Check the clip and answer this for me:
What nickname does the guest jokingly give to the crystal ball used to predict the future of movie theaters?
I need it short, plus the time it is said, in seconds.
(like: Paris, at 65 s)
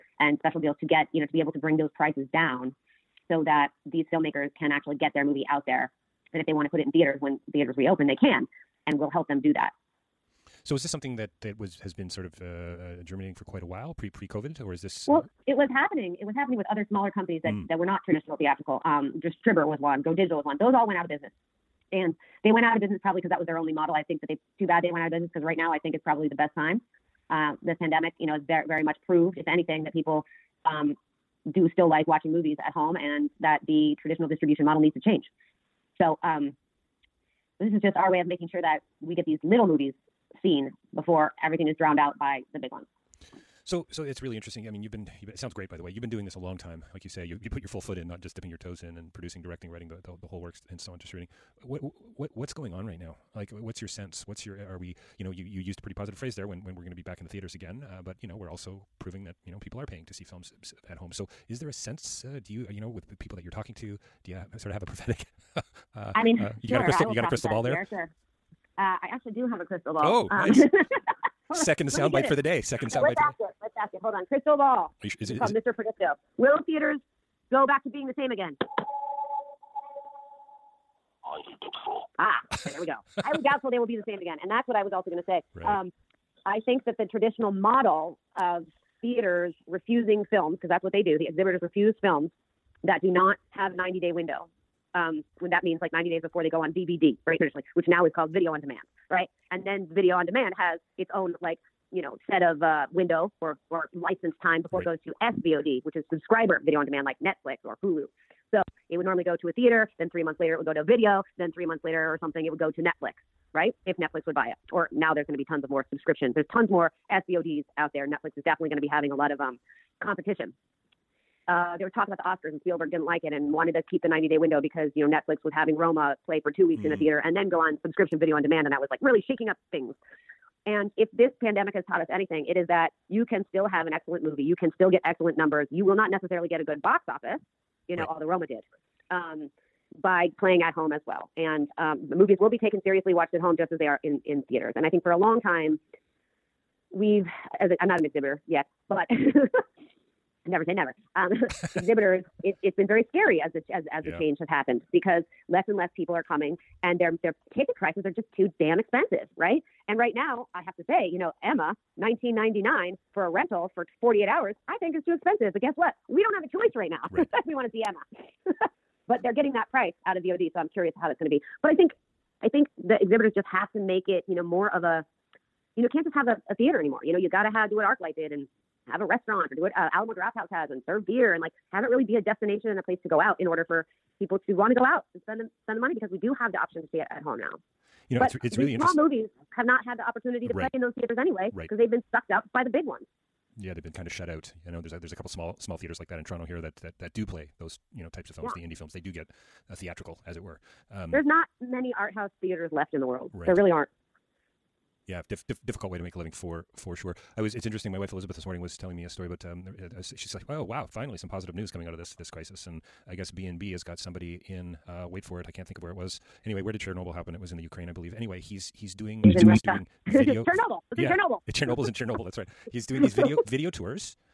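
Mr. Predicto, at 75 s.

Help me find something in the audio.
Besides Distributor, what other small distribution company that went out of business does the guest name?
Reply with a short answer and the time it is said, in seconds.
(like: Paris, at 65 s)
Go Digital, at 20 s.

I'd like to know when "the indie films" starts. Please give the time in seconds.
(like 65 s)
198 s.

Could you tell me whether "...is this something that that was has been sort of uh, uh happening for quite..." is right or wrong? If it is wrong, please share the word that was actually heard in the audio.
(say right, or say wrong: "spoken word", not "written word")
wrong: "germinating", not "happening".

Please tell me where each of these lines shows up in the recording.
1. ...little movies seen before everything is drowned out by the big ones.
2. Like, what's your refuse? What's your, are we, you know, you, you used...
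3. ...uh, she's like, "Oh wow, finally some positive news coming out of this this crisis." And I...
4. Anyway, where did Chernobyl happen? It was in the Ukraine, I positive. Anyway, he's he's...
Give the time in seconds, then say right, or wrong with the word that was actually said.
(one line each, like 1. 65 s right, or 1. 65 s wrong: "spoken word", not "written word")
1. 39 s right
2. 53 s wrong: "sense", not "refuse"
3. 209 s right
4. 216 s wrong: "believe", not "positive".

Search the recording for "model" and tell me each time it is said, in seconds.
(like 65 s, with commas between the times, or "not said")
23 s, 34 s, 87 s.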